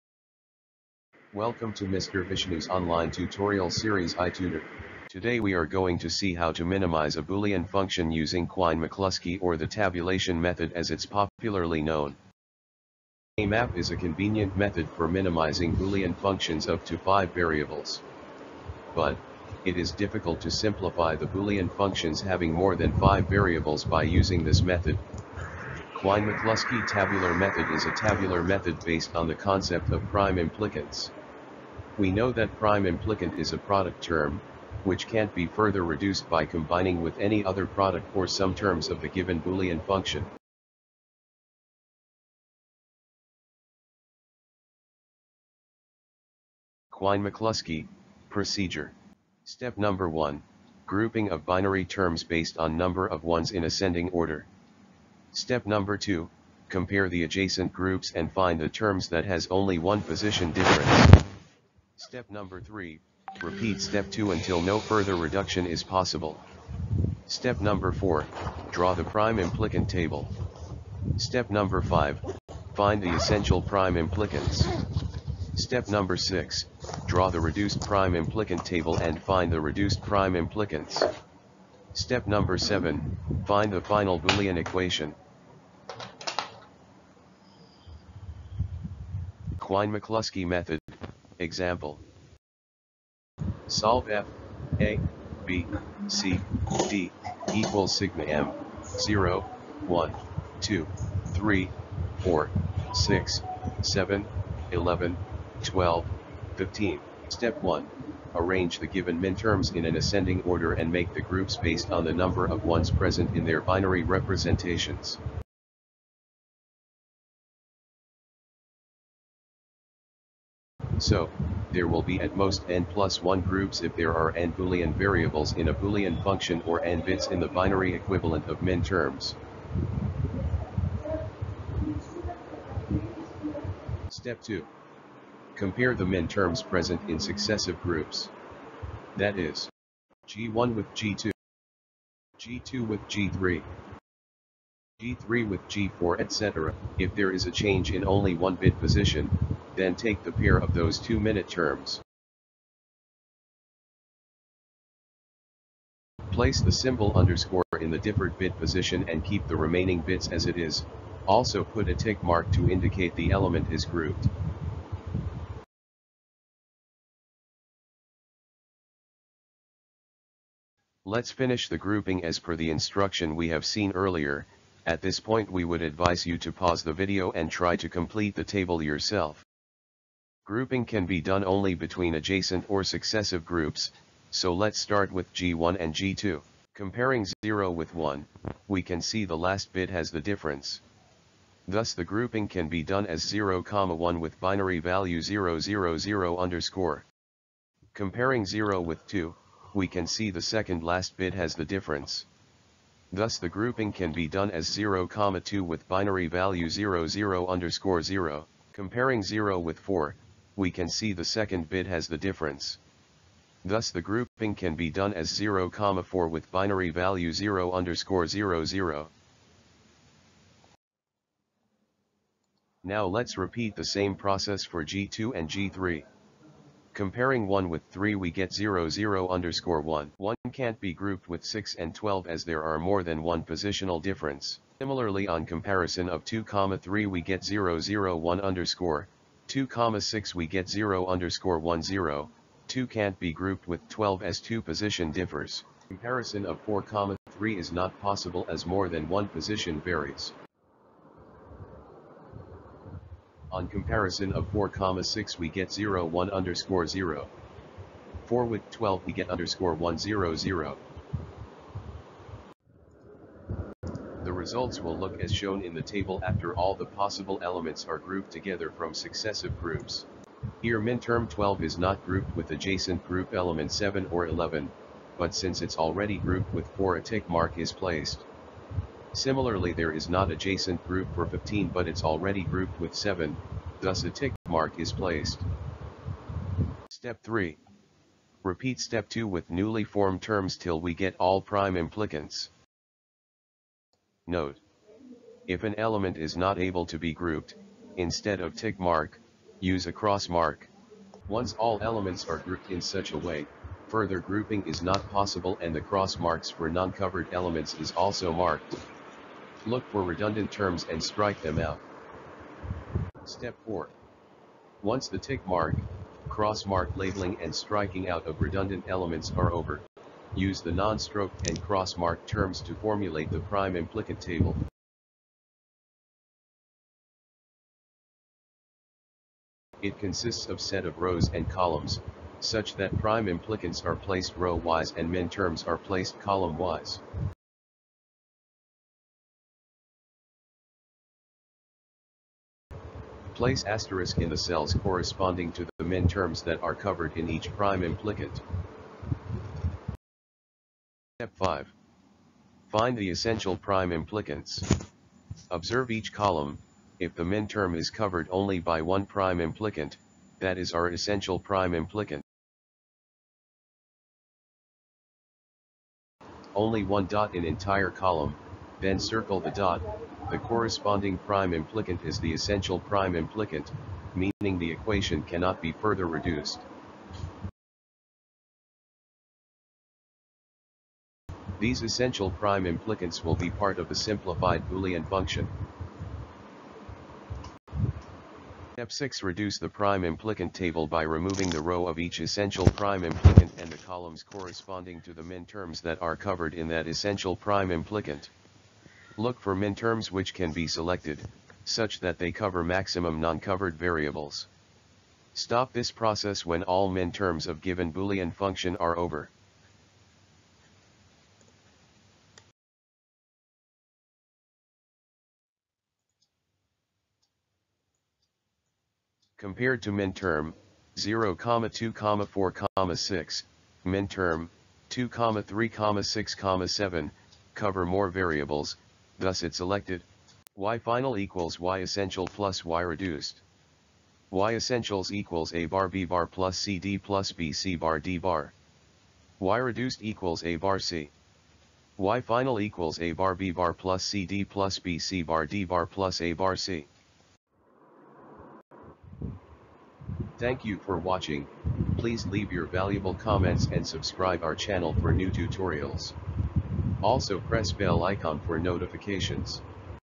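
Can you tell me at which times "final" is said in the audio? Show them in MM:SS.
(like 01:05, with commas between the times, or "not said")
01:23, 07:10, 07:22.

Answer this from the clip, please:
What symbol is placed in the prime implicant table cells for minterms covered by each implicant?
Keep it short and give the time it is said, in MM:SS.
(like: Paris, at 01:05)
asterisk, at 05:43.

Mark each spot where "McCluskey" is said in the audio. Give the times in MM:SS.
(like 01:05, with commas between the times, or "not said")
00:08, 00:25, 00:46, 01:29.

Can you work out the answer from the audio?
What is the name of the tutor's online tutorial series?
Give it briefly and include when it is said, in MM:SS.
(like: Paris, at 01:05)
iTutor, at 00:04.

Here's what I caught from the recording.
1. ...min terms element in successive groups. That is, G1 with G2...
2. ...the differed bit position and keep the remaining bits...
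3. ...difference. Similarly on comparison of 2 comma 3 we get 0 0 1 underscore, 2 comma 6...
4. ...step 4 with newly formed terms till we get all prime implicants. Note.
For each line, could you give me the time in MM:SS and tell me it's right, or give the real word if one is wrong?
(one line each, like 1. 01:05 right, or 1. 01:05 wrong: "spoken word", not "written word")
1. 02:16 wrong: "present", not "element"
2. 02:37 right
3. 03:54 right
4. 04:48 wrong: "2", not "4".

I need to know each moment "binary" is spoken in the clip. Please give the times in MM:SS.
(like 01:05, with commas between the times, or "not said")
00:51, 01:53, 02:07, 03:14, 03:25, 03:36.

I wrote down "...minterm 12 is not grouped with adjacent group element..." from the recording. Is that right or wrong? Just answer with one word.
right.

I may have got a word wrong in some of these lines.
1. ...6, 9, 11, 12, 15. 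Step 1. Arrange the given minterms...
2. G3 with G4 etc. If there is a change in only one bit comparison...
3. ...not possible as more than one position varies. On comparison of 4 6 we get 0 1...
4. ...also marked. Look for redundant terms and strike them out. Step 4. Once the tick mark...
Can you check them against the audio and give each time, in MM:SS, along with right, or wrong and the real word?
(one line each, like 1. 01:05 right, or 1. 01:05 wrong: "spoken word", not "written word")
1. 01:42 wrong: "7", not "9"
2. 02:25 wrong: "position", not "comparison"
3. 04:07 right
4. 05:07 right.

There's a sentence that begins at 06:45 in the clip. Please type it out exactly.
Stop this process when all min terms of given Boolean function are over.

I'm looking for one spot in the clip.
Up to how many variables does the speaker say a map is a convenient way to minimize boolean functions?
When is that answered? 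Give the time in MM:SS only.
00:16.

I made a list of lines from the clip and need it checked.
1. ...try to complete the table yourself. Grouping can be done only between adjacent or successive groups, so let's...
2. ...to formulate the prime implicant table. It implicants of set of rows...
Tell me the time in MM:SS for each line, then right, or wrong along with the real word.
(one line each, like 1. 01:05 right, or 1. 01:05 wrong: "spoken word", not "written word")
1. 02:57 right
2. 05:22 wrong: "consists", not "implicants".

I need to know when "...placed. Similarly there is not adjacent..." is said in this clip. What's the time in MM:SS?
04:37.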